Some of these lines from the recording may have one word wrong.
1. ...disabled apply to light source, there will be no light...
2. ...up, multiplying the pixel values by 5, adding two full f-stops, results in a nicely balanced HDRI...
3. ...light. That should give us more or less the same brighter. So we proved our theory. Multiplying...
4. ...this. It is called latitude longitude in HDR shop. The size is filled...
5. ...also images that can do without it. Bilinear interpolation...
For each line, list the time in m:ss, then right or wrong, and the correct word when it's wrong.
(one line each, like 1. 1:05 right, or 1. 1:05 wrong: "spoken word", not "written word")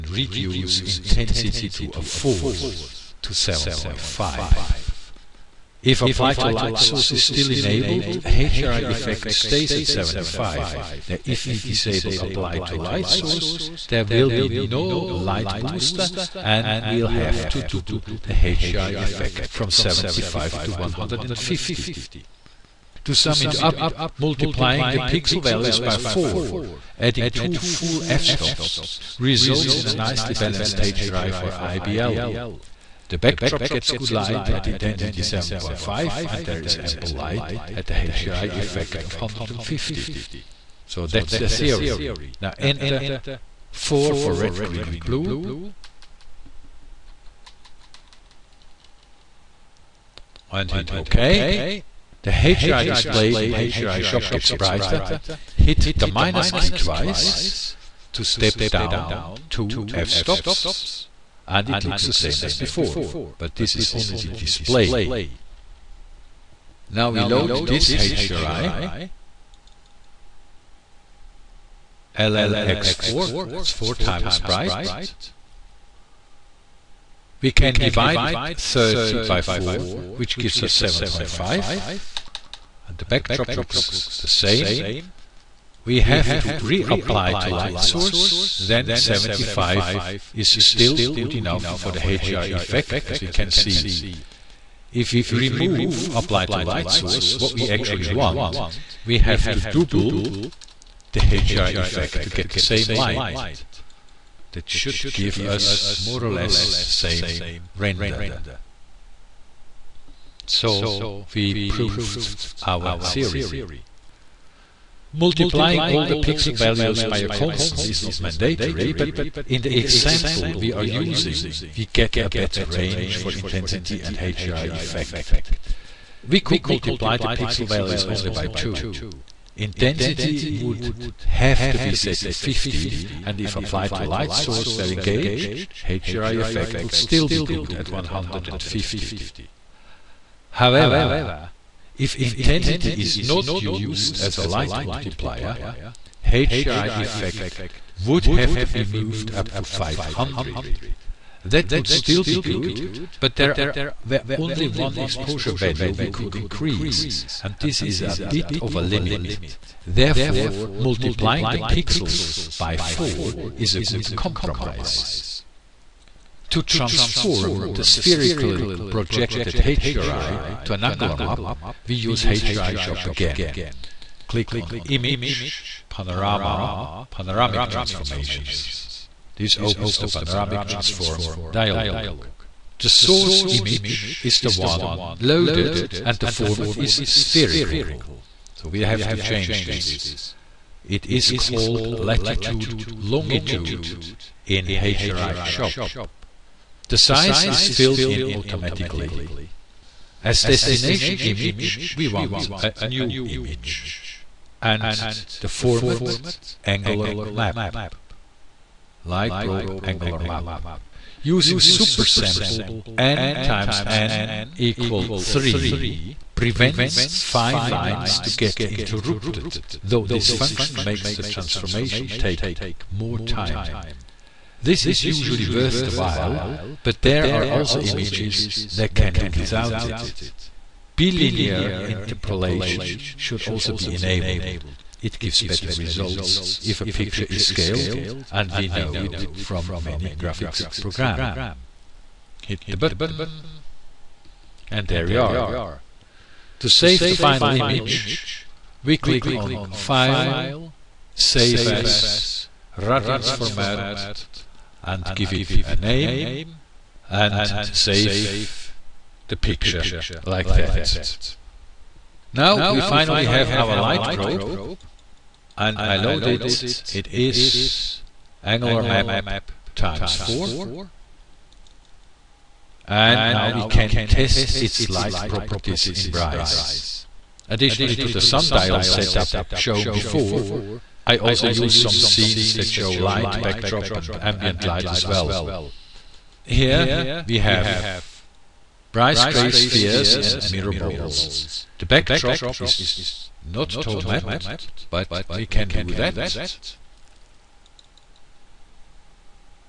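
1. 0:11 right
2. 0:23 wrong: "4", not "5"
3. 1:42 wrong: "render", not "brighter"
4. 3:09 right
5. 3:47 right.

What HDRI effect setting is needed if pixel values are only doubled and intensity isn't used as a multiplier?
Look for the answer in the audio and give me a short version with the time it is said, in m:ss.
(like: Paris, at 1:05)
500, at 2:29.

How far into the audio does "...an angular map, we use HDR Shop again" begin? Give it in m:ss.
2:50.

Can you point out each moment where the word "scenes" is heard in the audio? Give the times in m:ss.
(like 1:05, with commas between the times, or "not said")
4:41.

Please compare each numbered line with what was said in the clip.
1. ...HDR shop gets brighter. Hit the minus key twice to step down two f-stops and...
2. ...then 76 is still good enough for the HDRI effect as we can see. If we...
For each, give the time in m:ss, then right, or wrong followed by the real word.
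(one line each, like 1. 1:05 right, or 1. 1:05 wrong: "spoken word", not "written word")
1. 0:53 right
2. 1:28 wrong: "75", not "76".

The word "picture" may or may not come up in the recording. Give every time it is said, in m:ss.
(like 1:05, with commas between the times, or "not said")
3:56, 4:19.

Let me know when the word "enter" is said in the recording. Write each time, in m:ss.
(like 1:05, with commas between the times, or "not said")
0:42.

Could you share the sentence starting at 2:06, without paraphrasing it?
We could multiply the pixel values only by 2.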